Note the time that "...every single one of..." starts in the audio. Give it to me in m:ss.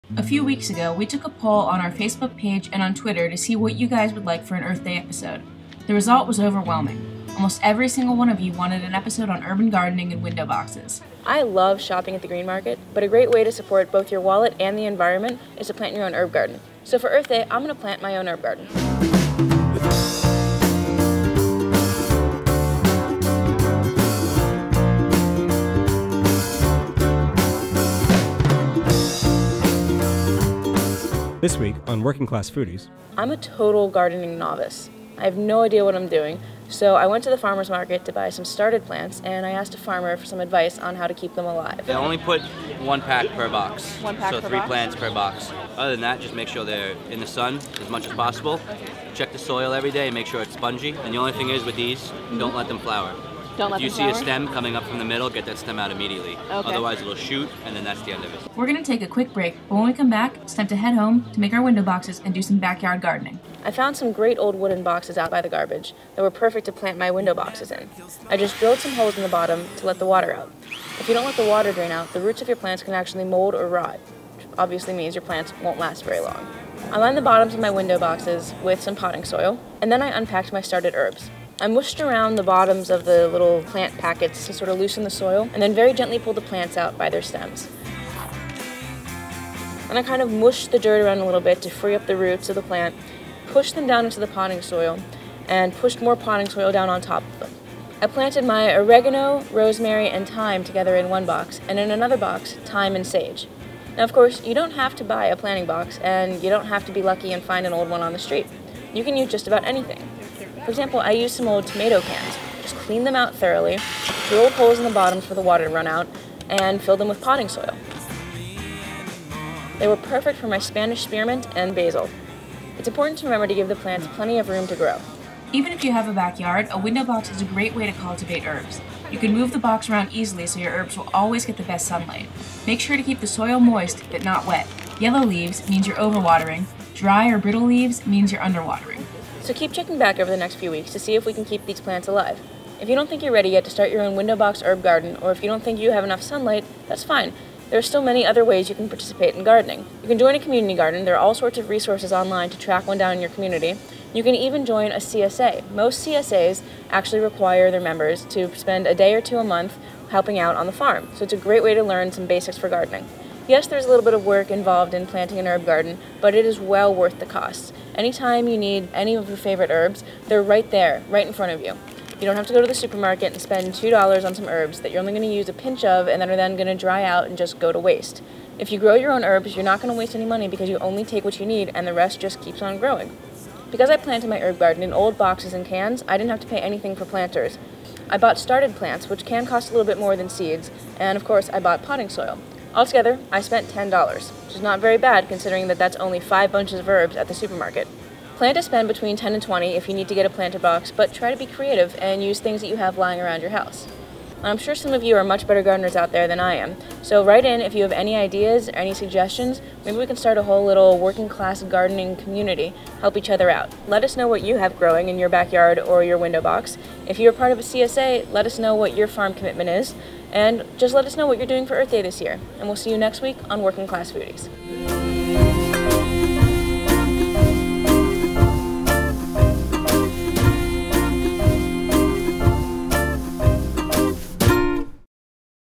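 0:07.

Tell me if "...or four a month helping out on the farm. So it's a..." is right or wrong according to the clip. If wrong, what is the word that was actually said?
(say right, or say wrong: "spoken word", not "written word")
wrong: "two", not "four".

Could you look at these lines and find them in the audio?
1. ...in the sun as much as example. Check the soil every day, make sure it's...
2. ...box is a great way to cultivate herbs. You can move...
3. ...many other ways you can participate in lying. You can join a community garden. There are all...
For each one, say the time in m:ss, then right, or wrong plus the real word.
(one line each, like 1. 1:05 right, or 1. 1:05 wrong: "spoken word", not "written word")
1. 0:47 wrong: "possible", not "example"
2. 2:07 right
3. 2:28 wrong: "gardening", not "lying".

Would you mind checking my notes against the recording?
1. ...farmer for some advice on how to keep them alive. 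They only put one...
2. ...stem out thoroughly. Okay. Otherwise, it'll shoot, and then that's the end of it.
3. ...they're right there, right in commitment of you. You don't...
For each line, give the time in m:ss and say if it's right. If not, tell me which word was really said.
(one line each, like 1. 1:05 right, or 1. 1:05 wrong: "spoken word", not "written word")
1. 0:39 right
2. 0:55 wrong: "immediately", not "thoroughly"
3. 2:50 wrong: "front", not "commitment".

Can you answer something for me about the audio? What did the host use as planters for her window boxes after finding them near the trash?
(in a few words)
Old wooden boxes.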